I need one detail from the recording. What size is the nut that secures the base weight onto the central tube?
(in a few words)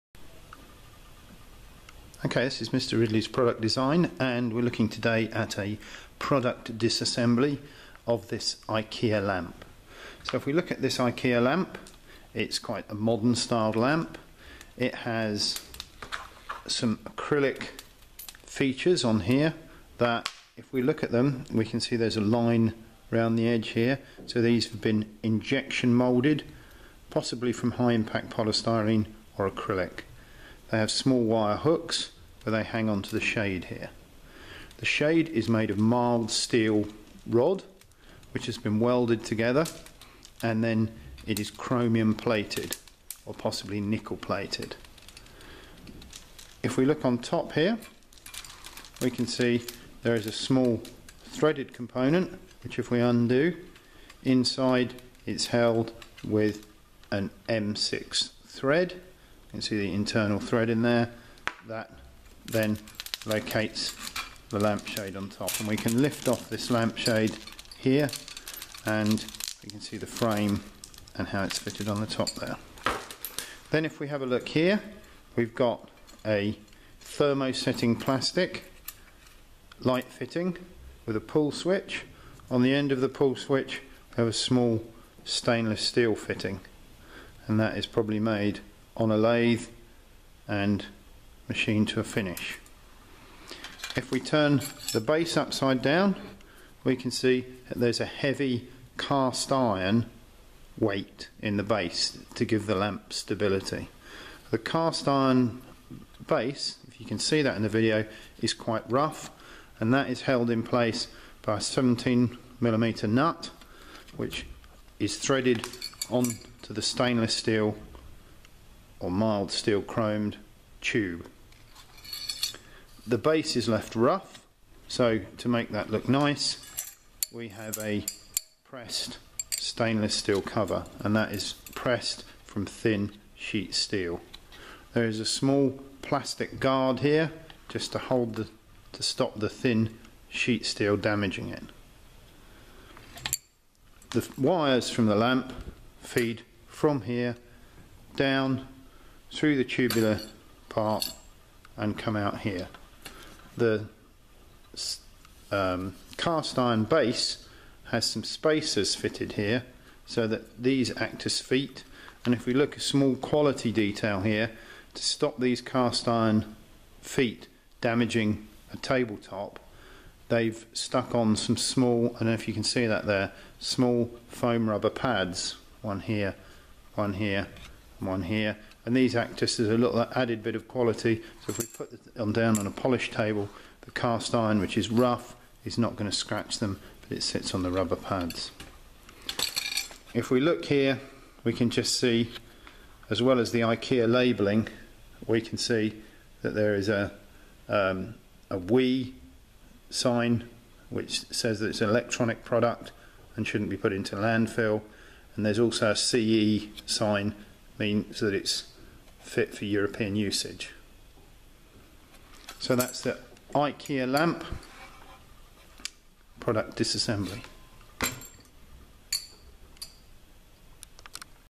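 17 millimeters.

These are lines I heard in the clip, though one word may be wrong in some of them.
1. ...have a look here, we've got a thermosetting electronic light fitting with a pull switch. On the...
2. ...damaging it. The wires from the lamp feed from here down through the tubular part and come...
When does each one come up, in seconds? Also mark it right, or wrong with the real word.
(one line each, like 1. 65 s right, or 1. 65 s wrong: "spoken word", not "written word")
1. 74 s wrong: "plastic", not "electronic"
2. 140 s right.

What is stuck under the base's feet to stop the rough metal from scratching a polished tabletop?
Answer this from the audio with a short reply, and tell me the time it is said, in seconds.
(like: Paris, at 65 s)
Foam rubber pads, at 174 s.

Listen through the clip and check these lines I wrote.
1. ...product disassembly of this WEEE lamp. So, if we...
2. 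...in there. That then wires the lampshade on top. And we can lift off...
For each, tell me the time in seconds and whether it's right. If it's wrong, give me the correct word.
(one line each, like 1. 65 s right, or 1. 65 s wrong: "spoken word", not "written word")
1. 6 s wrong: "IKEA", not "WEEE"
2. 60 s wrong: "locates", not "wires".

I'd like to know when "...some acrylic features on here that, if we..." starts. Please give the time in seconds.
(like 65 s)
16 s.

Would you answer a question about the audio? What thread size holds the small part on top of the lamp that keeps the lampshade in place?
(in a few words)
M6.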